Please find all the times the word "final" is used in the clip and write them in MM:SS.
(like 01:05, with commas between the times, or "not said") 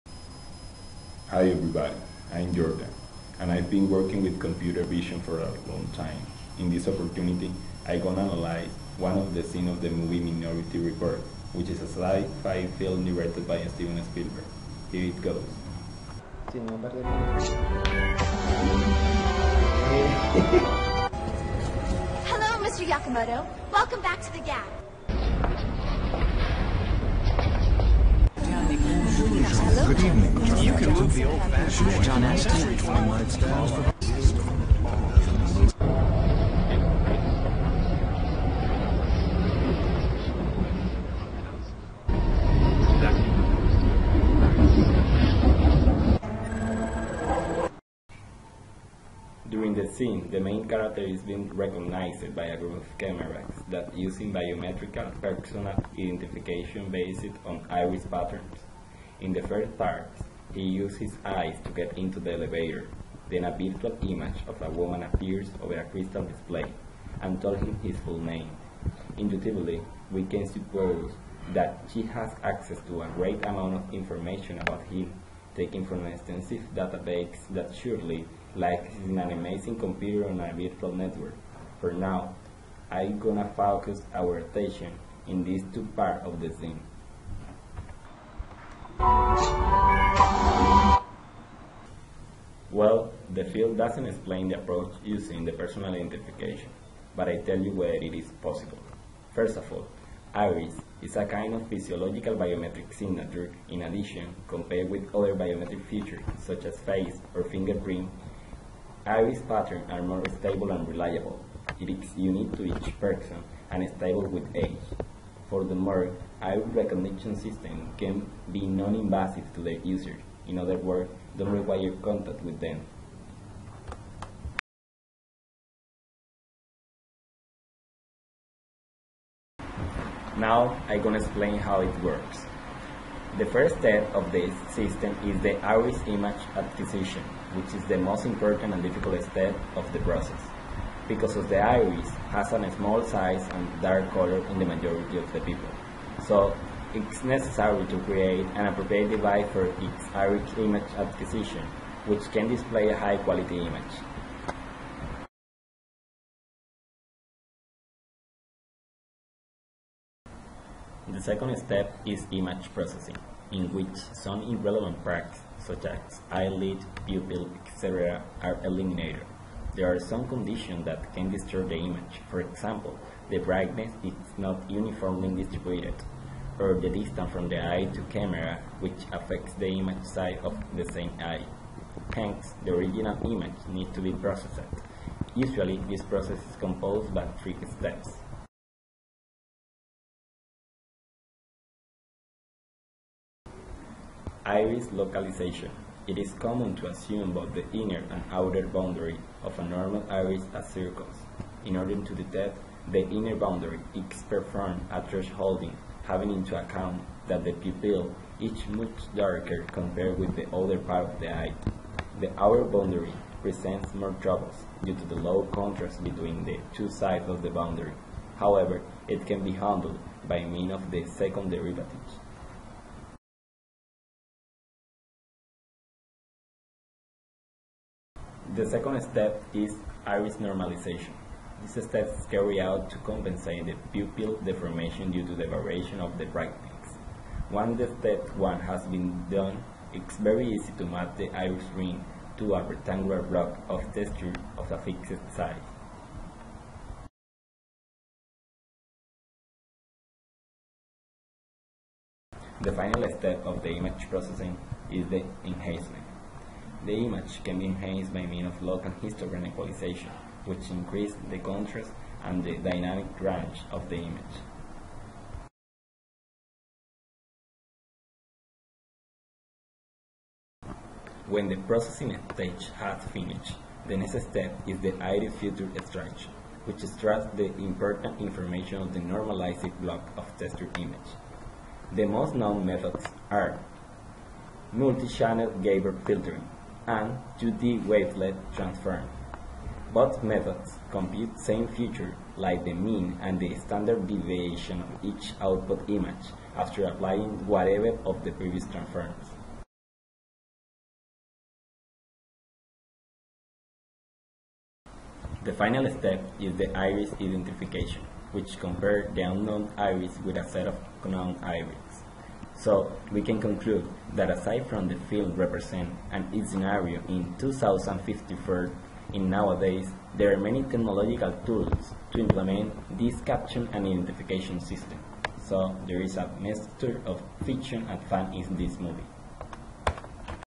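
04:12, 05:05.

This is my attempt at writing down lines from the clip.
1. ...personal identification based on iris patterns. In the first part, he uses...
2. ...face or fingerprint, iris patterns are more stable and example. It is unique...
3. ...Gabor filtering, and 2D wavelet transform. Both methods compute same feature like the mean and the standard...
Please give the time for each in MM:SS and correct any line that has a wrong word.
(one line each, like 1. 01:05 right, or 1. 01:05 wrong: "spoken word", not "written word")
1. 00:55 right
2. 01:46 wrong: "reliable", not "example"
3. 04:45 right.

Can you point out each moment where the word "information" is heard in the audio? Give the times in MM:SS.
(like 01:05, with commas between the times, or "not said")
01:13, 04:38.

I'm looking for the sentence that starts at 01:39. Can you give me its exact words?
First of all, iris is a kind of physiological biometric signature.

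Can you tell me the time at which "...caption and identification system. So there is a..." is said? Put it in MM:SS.
05:23.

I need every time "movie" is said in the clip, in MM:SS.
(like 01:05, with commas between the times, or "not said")
00:09, 05:28.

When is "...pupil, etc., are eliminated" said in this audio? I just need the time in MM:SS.
02:47.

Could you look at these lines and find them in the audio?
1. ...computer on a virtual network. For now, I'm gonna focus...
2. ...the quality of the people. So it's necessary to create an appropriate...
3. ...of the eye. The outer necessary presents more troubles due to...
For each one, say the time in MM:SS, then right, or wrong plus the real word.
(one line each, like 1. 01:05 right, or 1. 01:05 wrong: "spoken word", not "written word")
1. 01:19 right
2. 02:24 wrong: "majority", not "quality"
3. 03:31 wrong: "boundary", not "necessary".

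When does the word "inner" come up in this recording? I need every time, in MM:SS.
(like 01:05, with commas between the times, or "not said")
03:17, 03:23.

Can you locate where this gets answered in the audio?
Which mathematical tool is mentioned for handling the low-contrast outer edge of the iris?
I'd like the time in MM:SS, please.
03:41.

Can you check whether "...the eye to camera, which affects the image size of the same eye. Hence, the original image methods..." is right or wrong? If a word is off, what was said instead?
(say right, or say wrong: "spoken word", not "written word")
wrong: "needs", not "methods".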